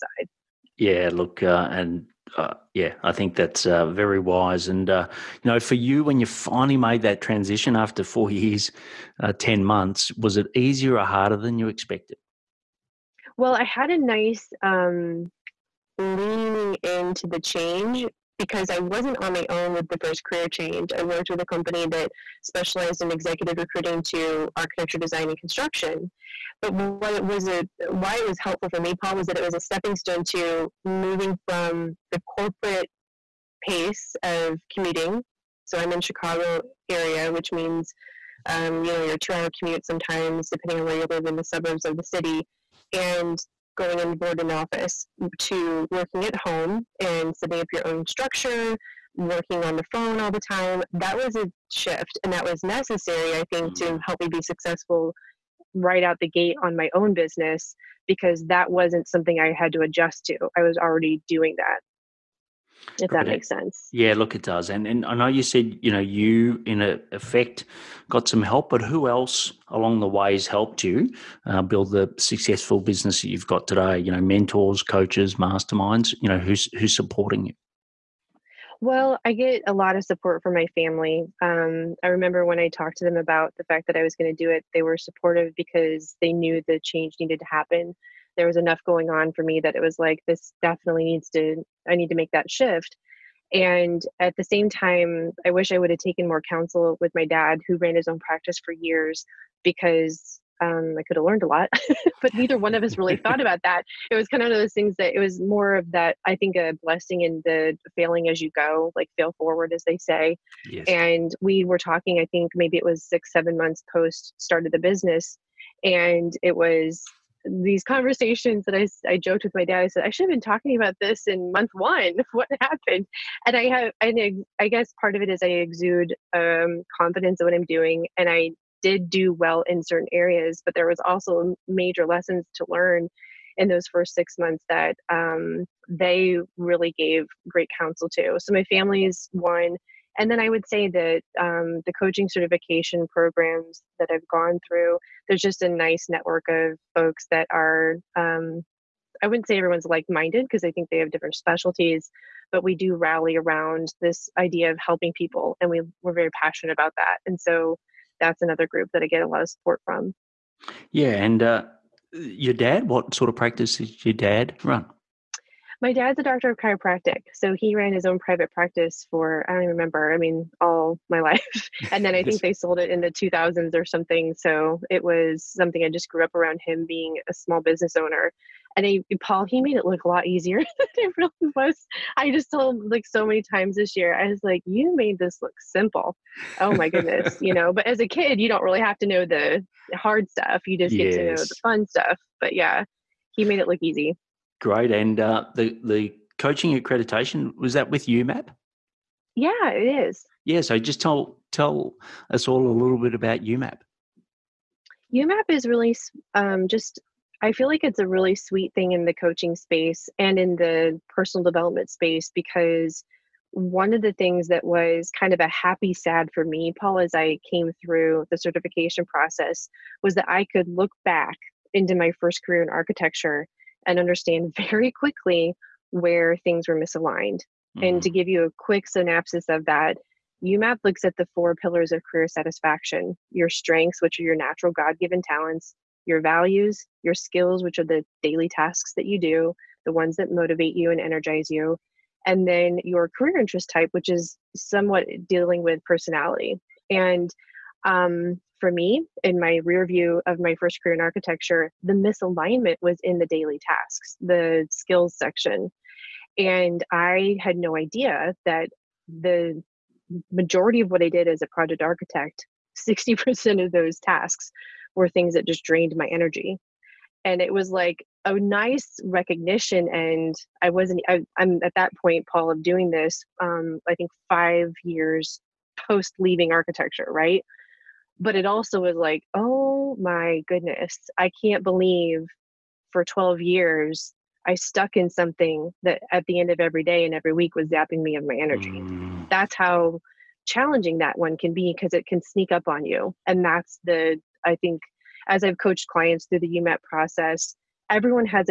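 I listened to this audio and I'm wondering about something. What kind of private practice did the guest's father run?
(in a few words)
Chiropractic.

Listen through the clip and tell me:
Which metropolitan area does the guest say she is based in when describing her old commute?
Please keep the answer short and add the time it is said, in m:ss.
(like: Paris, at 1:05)
Chicago, at 0:36.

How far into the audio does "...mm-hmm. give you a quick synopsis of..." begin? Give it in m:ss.
3:48.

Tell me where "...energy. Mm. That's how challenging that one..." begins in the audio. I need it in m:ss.
4:48.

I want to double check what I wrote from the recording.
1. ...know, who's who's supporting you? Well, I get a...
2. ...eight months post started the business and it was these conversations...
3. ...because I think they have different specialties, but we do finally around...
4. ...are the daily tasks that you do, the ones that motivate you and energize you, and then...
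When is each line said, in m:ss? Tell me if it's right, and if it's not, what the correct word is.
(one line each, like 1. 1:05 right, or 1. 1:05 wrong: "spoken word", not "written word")
1. 1:16 right
2. 1:53 wrong: "seven", not "eight"
3. 2:30 wrong: "rally", not "finally"
4. 3:57 right.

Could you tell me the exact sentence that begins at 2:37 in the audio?
And so that's another group that I get a lot of support from.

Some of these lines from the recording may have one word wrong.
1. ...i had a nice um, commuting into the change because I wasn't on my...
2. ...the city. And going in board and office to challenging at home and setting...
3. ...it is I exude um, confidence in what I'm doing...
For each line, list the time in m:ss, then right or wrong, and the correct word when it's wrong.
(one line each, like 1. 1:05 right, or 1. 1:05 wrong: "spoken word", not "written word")
1. 0:13 wrong: "leaning", not "commuting"
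2. 0:41 wrong: "working", not "challenging"
3. 2:05 right.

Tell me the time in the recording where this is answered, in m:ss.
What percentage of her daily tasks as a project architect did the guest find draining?
4:22.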